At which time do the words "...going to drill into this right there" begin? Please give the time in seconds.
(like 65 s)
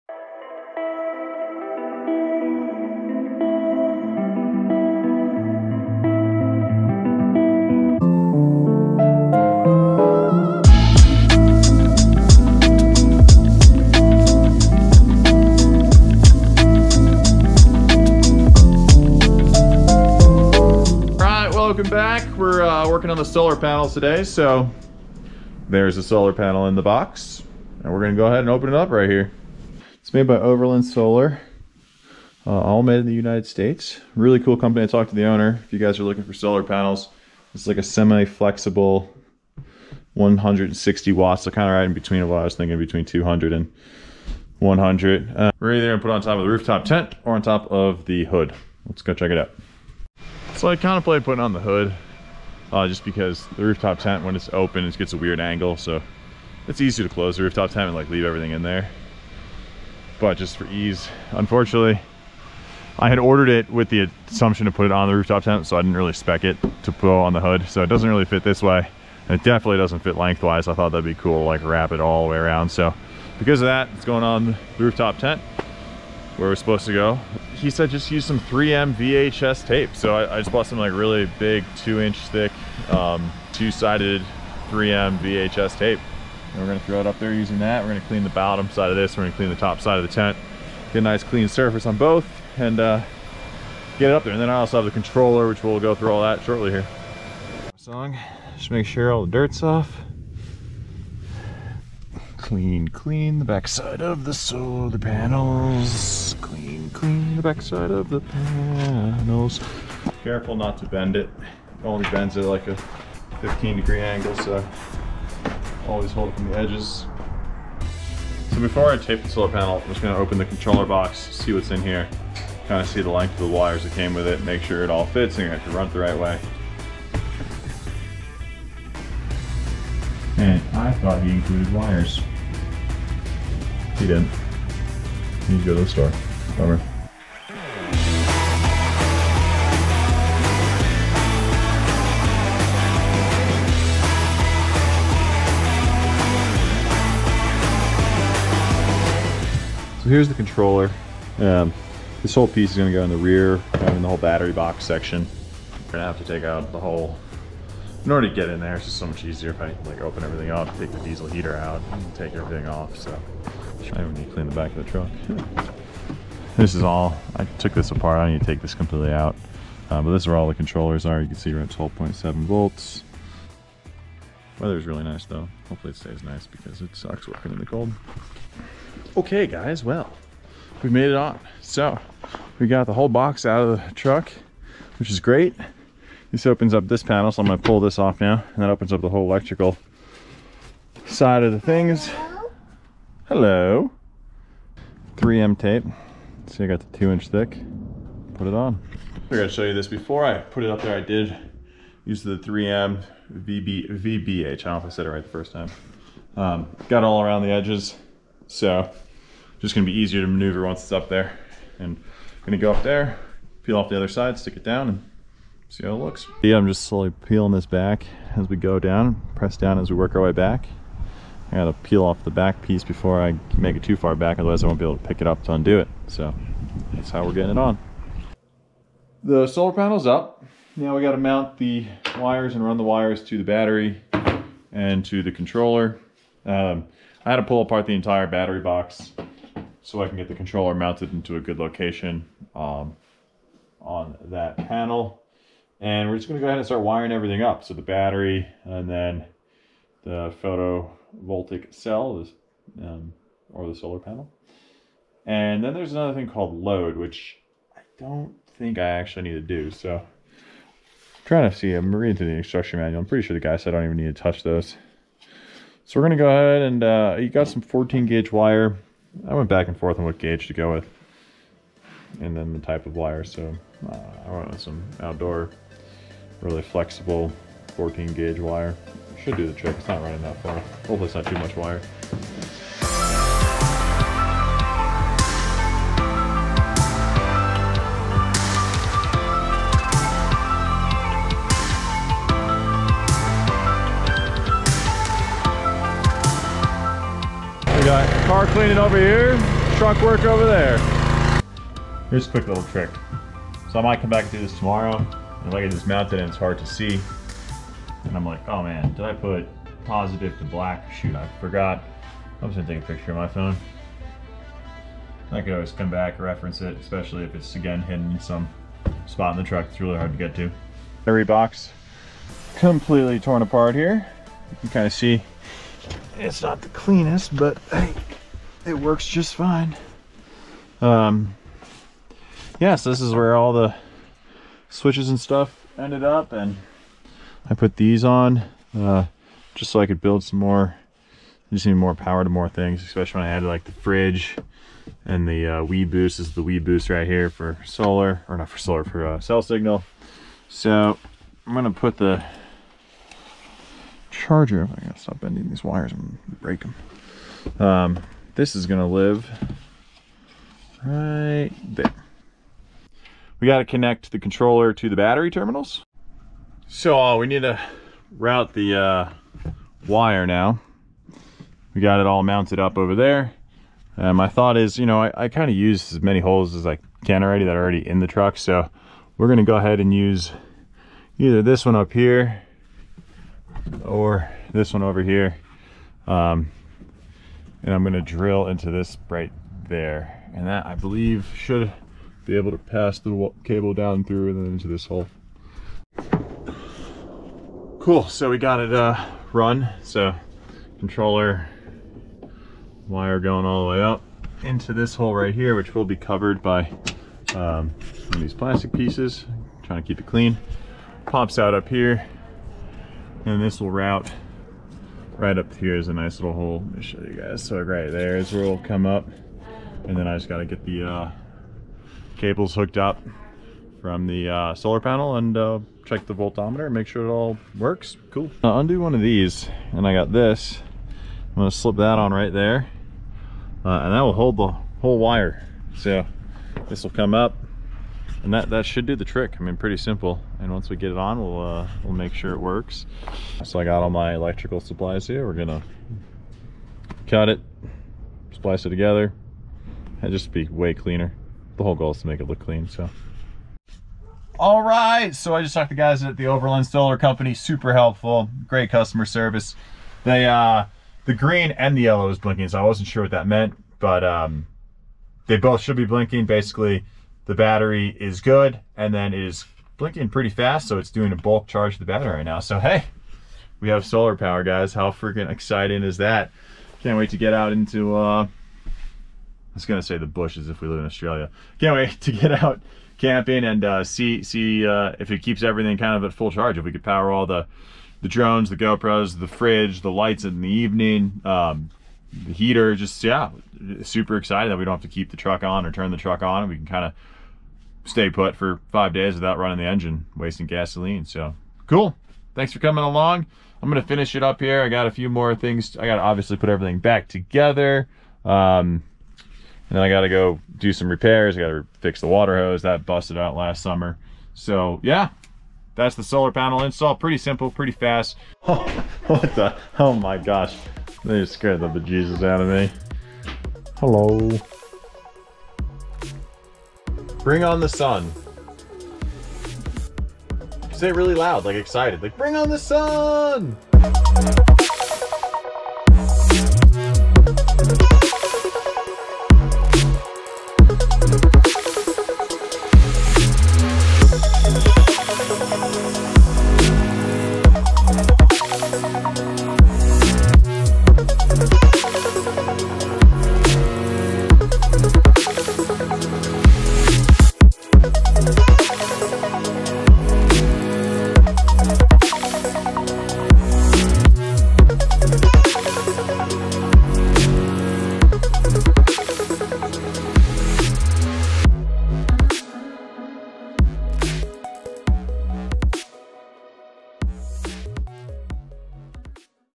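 387 s.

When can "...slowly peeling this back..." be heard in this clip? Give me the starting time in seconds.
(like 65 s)
216 s.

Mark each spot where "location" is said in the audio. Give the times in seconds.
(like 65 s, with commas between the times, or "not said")
241 s.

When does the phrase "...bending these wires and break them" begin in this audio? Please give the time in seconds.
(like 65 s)
355 s.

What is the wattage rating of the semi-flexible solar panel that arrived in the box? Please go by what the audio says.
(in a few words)
160 watts.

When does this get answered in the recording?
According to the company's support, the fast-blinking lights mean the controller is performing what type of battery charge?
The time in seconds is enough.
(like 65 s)
471 s.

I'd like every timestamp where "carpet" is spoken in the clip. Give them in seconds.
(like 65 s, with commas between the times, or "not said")
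not said.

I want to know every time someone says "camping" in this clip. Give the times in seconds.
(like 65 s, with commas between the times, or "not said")
483 s.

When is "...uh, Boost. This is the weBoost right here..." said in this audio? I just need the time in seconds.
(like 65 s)
345 s.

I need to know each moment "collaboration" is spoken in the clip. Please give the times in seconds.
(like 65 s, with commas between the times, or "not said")
not said.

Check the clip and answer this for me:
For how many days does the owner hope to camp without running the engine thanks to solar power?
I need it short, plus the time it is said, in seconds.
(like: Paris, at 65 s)
5 days, at 498 s.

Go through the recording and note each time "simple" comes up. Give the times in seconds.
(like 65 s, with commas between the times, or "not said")
439 s, 517 s.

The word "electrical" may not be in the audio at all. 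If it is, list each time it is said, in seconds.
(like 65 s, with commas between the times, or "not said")
189 s, 444 s.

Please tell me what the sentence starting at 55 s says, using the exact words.
So it's easy to close the rooftop tent and like leave everything in there.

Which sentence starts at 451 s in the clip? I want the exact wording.
The whole goal is to make it look clean, so.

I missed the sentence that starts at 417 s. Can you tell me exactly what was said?
So right there is where we will come up.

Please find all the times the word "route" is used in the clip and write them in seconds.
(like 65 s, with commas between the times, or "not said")
368 s, 413 s.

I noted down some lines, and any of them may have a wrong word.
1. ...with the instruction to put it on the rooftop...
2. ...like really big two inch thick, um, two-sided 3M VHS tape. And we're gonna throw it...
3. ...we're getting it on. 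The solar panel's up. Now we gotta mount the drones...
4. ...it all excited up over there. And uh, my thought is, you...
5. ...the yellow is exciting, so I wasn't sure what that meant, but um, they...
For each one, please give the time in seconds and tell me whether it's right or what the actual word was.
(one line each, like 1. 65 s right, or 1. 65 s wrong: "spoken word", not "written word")
1. 63 s wrong: "assumption", not "instruction"
2. 80 s right
3. 227 s wrong: "wires", not "drones"
4. 371 s wrong: "mounted", not "excited"
5. 461 s wrong: "blinking", not "exciting".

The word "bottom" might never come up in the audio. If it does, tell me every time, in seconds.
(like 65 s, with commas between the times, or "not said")
88 s.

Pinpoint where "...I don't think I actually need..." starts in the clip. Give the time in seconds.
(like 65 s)
257 s.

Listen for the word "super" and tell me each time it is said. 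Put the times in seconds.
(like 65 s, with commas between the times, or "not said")
457 s, 493 s.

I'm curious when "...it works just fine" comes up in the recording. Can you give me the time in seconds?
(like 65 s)
328 s.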